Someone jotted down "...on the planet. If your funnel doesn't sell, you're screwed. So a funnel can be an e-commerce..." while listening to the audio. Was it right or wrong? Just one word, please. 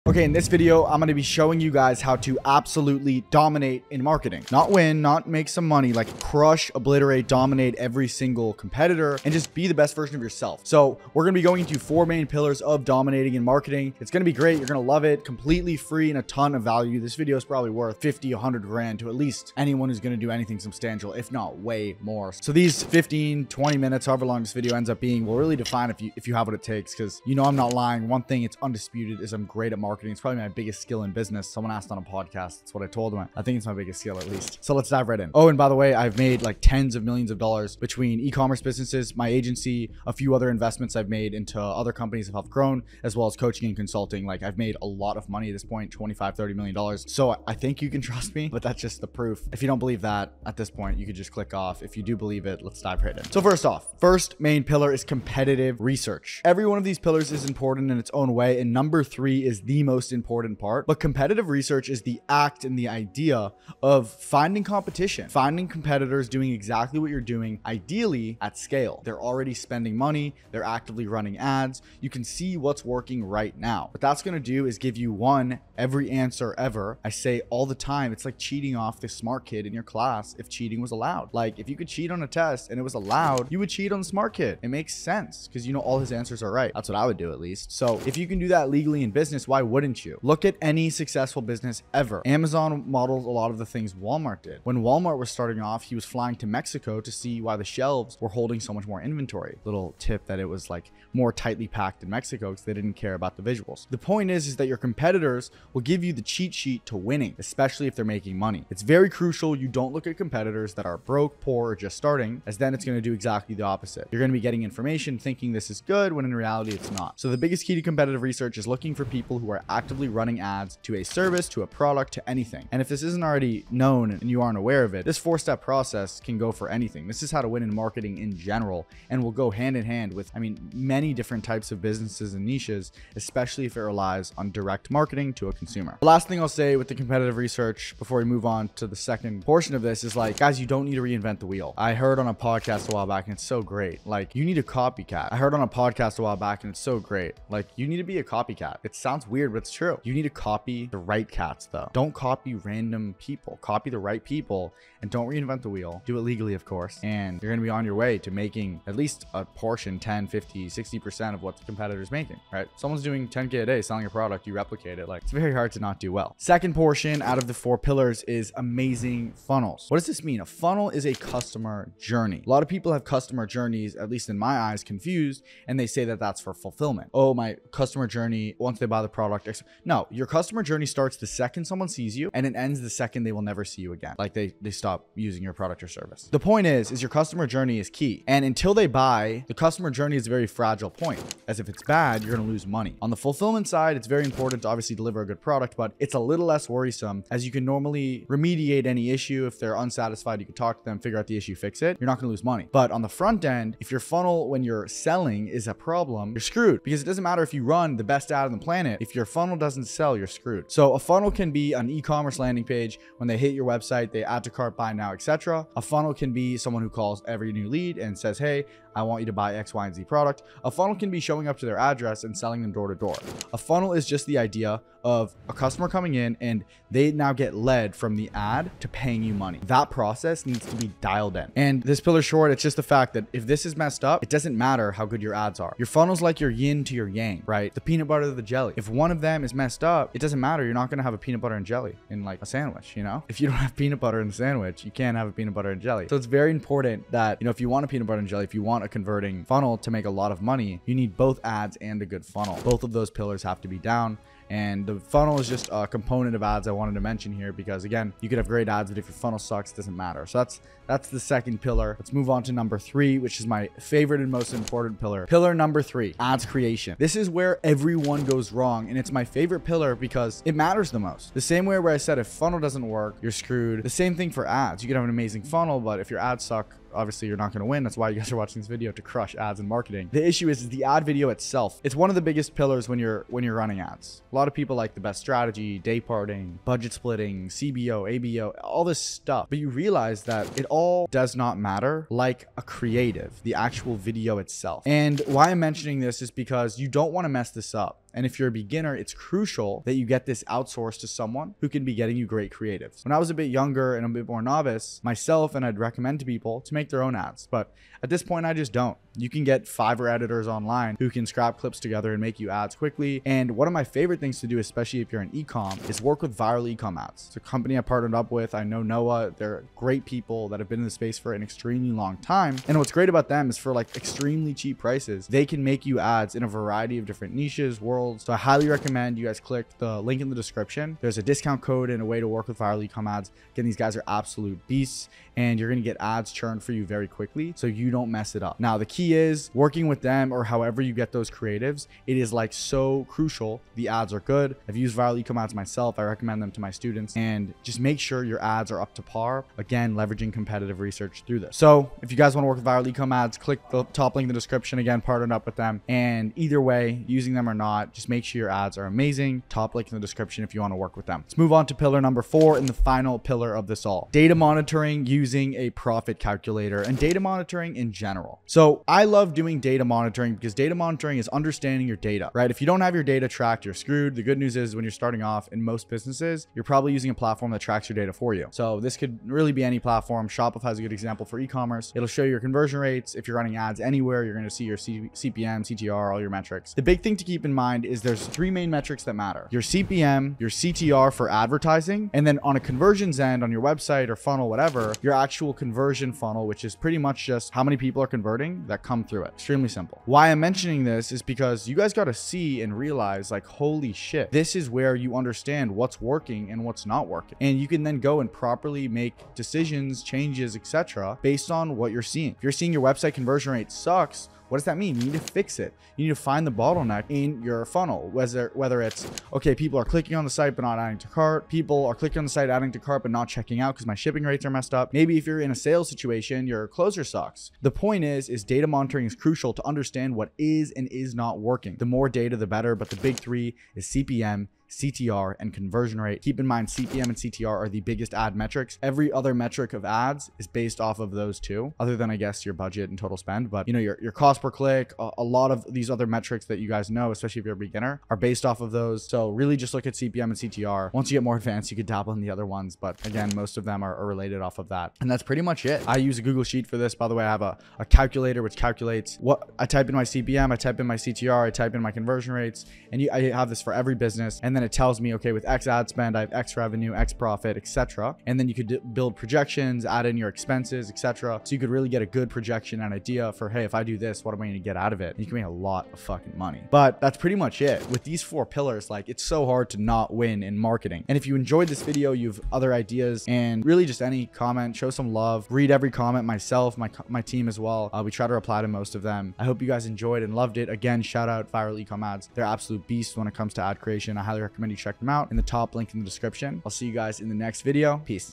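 right.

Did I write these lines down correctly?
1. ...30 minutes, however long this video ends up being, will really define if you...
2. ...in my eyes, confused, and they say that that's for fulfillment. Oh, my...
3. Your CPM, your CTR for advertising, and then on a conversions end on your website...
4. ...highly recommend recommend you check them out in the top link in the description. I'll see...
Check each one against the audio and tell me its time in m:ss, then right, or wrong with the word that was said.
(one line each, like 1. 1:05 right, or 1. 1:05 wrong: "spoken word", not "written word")
1. 0:23 wrong: "20", not "30"
2. 2:54 right
3. 6:29 right
4. 8:14 right.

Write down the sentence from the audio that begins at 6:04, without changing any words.
Data monitoring using a profit calculator and data monitoring in general.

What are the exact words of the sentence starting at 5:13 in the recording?
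And one of my favorite things to do, especially if you're an ecom, is work with viral ecom ads.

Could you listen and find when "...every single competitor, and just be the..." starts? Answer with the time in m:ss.
0:07.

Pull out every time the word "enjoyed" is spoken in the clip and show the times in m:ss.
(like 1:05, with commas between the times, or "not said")
8:01, 8:09.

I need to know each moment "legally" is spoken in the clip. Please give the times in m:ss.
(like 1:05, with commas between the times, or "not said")
1:28, 2:36.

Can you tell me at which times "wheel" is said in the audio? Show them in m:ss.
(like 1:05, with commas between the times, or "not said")
2:21, 2:35.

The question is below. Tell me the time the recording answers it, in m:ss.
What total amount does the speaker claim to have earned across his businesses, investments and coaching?
0:45.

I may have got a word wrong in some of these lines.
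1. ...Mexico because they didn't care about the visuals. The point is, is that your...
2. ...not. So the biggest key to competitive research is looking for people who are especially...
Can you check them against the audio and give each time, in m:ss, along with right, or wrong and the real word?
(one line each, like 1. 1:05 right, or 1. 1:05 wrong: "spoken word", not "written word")
1. 1:42 right
2. 1:56 wrong: "actively", not "especially".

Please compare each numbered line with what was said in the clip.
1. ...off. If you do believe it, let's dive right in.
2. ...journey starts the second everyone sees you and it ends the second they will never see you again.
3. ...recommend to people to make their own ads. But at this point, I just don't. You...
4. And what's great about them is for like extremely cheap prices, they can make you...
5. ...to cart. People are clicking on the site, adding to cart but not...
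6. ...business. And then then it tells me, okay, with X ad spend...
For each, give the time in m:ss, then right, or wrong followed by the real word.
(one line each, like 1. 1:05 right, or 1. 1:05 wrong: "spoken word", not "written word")
1. 0:51 right
2. 3:00 wrong: "someone", not "everyone"
3. 5:05 right
4. 5:22 right
5. 7:00 right
6. 7:43 right.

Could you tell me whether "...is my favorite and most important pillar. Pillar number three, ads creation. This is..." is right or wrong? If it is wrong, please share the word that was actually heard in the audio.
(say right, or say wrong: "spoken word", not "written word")
right.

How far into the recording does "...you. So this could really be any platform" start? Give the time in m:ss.
6:18.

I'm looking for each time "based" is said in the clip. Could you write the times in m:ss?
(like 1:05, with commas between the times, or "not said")
6:51, 7:20, 7:28.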